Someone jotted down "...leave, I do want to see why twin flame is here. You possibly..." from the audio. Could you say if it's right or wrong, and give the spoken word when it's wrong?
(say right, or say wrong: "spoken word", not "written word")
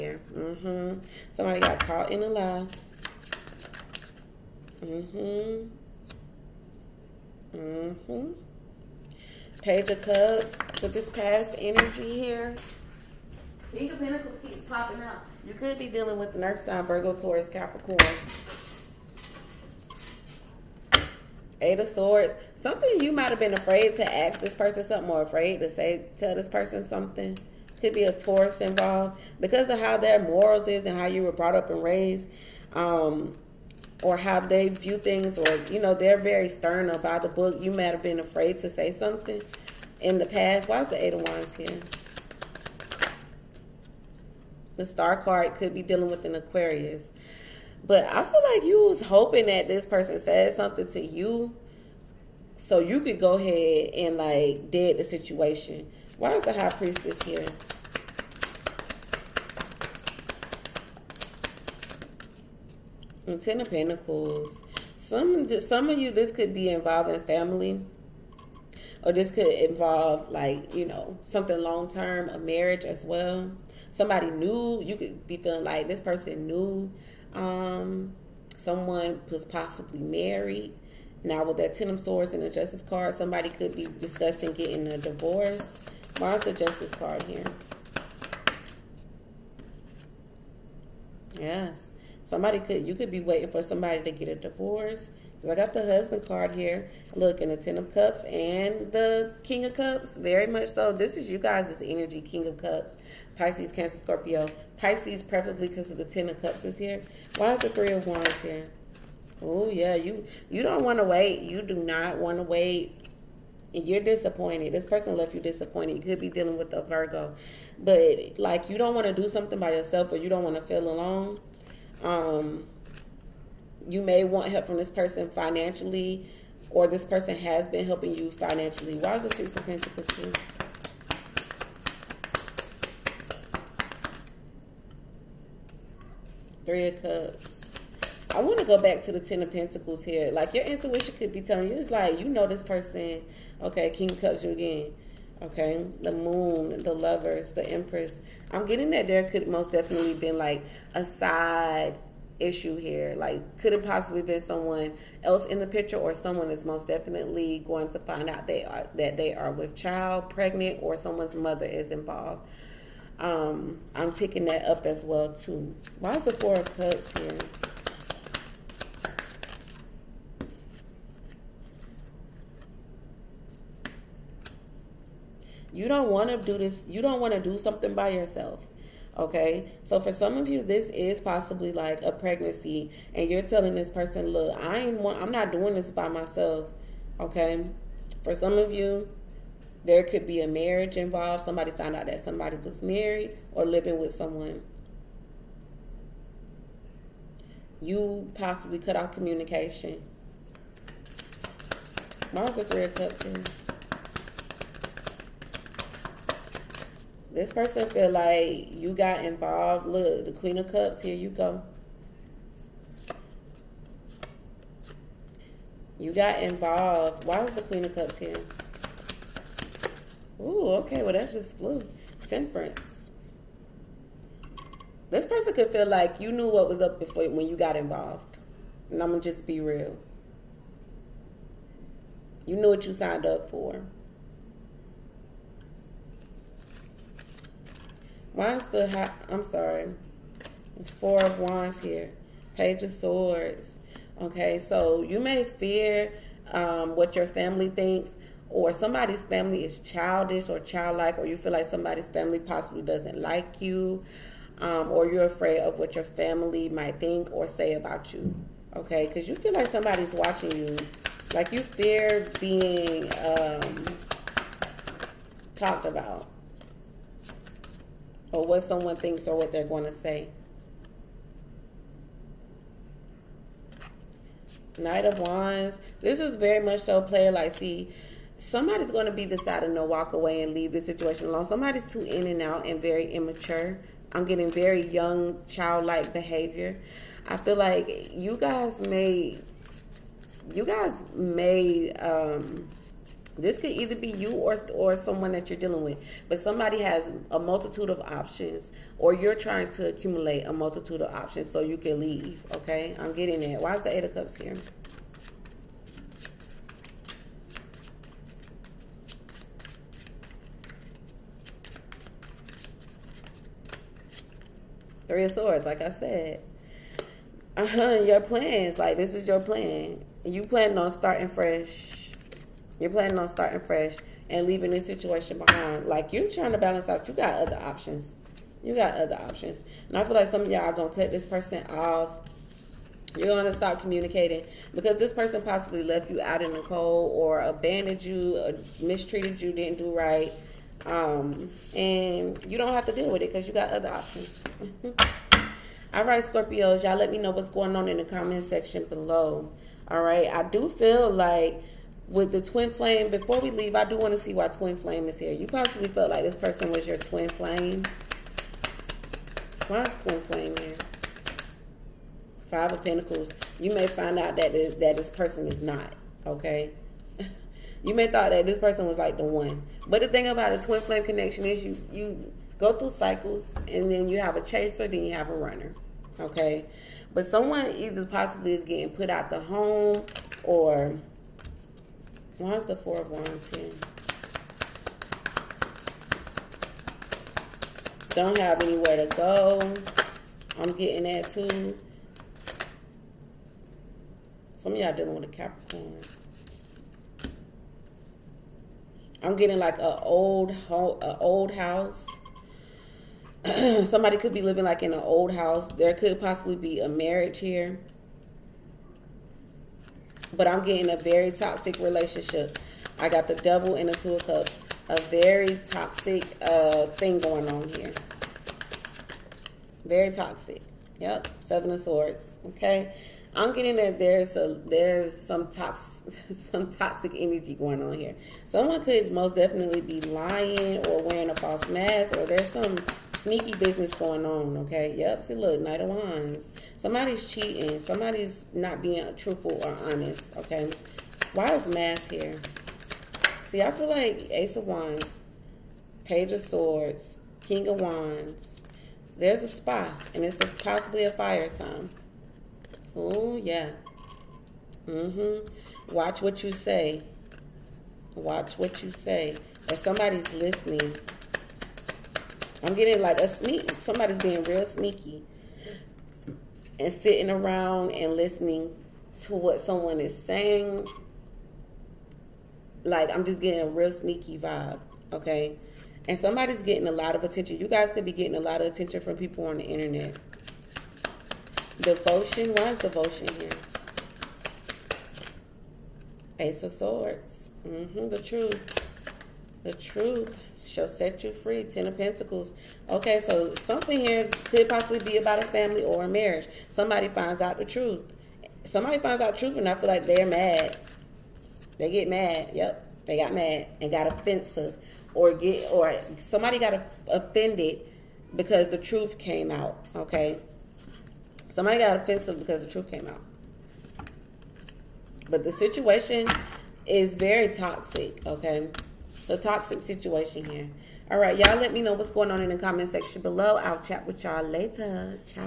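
right.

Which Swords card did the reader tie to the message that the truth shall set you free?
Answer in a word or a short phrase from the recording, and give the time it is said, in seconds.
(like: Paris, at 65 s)
Ace of Swords, at 486 s.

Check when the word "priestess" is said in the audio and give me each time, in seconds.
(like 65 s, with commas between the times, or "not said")
56 s.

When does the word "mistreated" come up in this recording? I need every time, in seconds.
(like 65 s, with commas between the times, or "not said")
338 s.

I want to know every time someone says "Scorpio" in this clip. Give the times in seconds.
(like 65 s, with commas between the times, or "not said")
103 s, 346 s.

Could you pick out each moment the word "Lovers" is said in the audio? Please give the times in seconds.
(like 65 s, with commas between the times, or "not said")
146 s.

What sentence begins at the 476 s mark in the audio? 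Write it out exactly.
And somebody's getting a lot of attention.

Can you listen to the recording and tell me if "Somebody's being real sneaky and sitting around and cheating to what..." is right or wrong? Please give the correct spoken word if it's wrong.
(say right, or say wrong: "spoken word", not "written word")
wrong: "listening", not "cheating".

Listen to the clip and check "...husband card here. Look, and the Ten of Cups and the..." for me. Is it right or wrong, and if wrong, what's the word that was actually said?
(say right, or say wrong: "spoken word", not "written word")
right.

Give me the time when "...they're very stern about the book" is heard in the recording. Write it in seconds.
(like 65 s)
35 s.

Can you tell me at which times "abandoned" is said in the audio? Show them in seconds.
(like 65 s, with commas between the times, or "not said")
337 s.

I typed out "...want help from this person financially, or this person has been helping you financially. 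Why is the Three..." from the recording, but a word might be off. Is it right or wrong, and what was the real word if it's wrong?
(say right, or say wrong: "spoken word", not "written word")
wrong: "Six", not "Three".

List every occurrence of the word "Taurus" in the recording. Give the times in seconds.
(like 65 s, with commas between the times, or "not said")
17 s, 28 s.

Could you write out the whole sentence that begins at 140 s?
Like your intuition could be telling you, it's like you know this person.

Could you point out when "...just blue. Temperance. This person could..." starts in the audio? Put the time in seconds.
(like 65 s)
221 s.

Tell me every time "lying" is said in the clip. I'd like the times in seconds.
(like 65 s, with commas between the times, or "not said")
430 s.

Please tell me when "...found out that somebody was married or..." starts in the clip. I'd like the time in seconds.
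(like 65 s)
191 s.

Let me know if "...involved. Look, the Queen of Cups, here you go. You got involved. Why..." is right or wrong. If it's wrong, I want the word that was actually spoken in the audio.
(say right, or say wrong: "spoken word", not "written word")
right.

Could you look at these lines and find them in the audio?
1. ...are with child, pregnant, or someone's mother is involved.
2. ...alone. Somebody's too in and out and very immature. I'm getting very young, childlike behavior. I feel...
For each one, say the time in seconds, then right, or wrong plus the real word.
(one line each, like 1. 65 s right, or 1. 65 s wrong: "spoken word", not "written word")
1. 159 s right
2. 281 s right.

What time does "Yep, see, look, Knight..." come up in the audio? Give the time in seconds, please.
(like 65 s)
434 s.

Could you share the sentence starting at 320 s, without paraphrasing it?
You planning on starting fresh you're planning on starting fresh and leaving this situation behind.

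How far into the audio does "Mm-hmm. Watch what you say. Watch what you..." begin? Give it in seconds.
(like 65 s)
454 s.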